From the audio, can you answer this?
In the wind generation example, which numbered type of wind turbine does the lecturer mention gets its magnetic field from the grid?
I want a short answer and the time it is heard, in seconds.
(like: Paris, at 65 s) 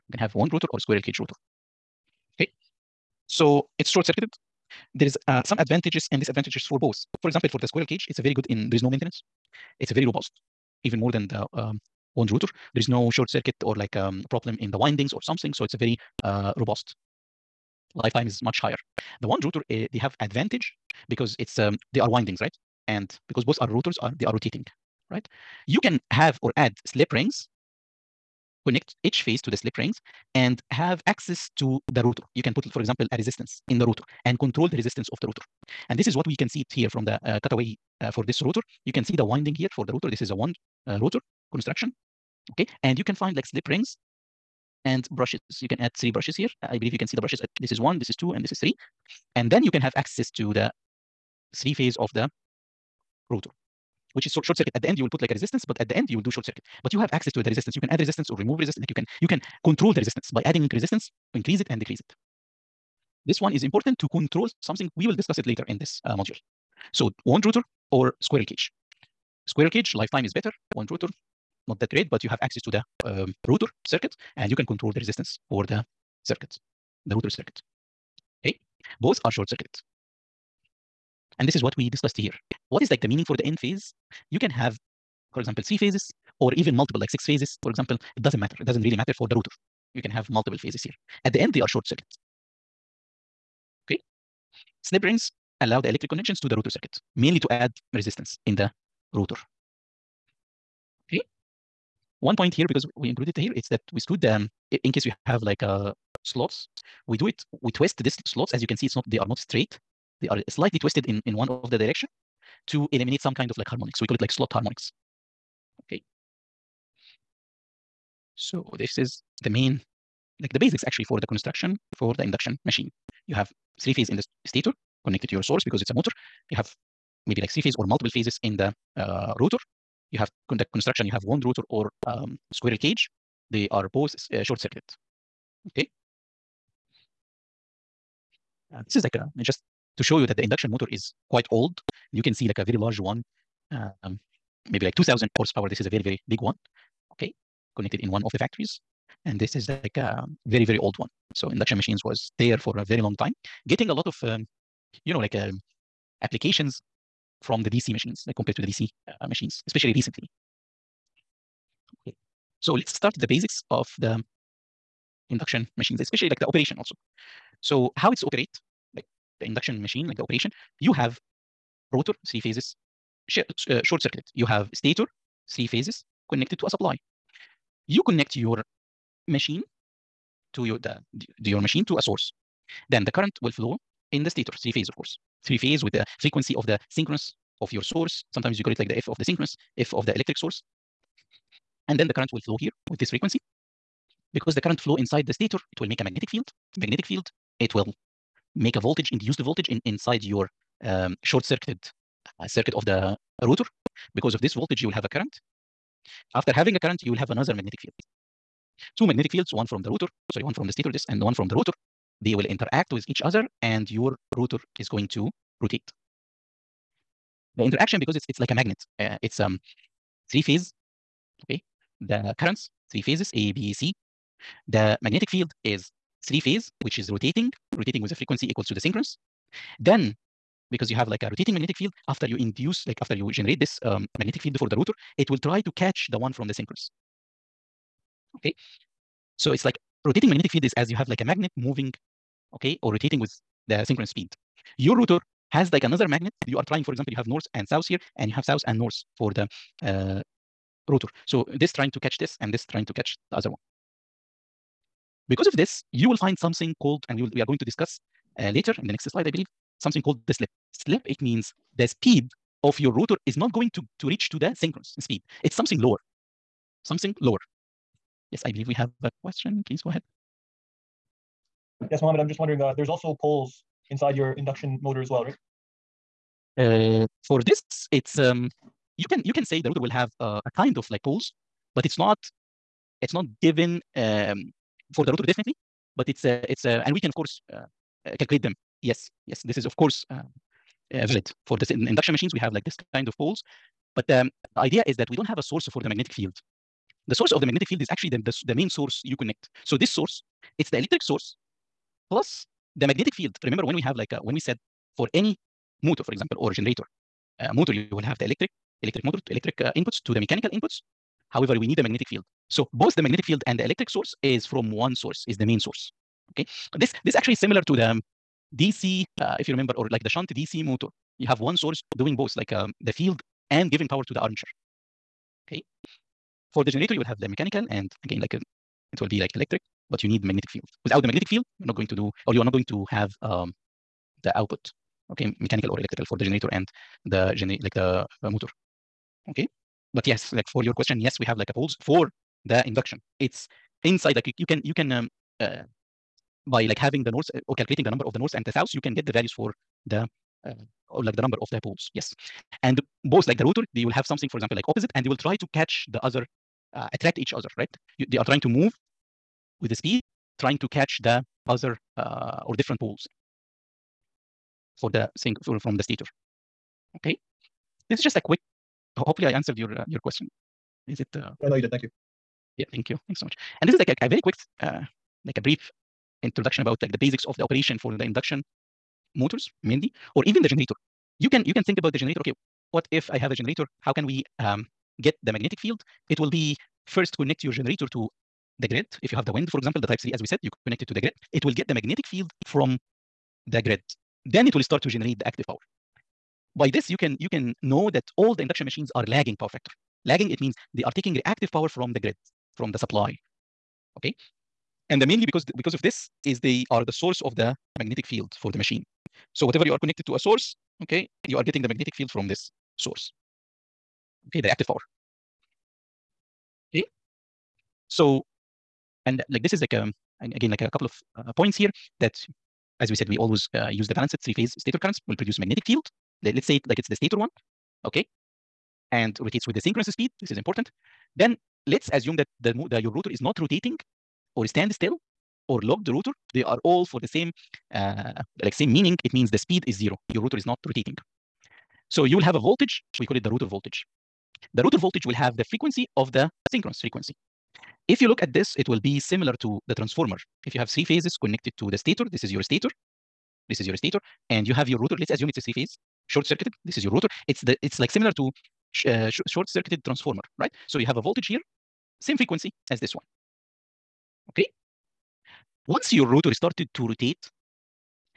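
type 3, at 389 s.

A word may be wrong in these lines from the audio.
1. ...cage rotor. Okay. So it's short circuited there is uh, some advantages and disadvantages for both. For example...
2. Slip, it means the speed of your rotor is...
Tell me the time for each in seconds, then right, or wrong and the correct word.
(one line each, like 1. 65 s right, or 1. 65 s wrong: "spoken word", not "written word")
1. 1 s right
2. 260 s right.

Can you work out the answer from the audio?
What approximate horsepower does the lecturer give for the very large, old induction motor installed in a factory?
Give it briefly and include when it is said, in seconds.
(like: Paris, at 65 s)
2000 horsepower, at 144 s.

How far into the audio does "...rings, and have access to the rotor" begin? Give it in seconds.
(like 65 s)
29 s.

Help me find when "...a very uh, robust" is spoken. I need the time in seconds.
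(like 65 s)
15 s.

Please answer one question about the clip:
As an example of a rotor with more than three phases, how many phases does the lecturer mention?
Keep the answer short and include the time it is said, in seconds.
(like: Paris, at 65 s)
6, at 87 s.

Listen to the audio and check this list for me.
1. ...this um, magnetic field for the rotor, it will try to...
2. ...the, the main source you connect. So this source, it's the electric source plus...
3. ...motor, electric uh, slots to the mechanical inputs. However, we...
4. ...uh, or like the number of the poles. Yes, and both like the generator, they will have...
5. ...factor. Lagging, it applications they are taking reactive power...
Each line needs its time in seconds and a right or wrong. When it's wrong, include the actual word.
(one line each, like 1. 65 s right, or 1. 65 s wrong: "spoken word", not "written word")
1. 233 s right
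2. 298 s right
3. 309 s wrong: "inputs", not "slots"
4. 350 s wrong: "rotor", not "generator"
5. 399 s wrong: "means", not "applications".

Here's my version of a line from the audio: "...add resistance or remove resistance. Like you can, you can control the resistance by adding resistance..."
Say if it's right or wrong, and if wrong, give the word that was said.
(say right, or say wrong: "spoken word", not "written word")
right.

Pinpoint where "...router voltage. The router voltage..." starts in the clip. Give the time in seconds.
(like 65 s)
443 s.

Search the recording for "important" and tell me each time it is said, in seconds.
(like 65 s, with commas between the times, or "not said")
63 s, 430 s.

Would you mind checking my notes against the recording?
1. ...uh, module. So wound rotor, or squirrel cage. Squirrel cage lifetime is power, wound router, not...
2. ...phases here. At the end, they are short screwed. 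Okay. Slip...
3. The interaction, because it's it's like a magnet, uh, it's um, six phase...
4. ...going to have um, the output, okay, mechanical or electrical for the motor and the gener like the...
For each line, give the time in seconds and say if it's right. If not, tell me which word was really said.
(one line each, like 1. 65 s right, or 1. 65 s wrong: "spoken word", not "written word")
1. 66 s wrong: "better", not "power"
2. 90 s wrong: "circuited", not "screwed"
3. 217 s wrong: "three", not "six"
4. 332 s wrong: "generator", not "motor".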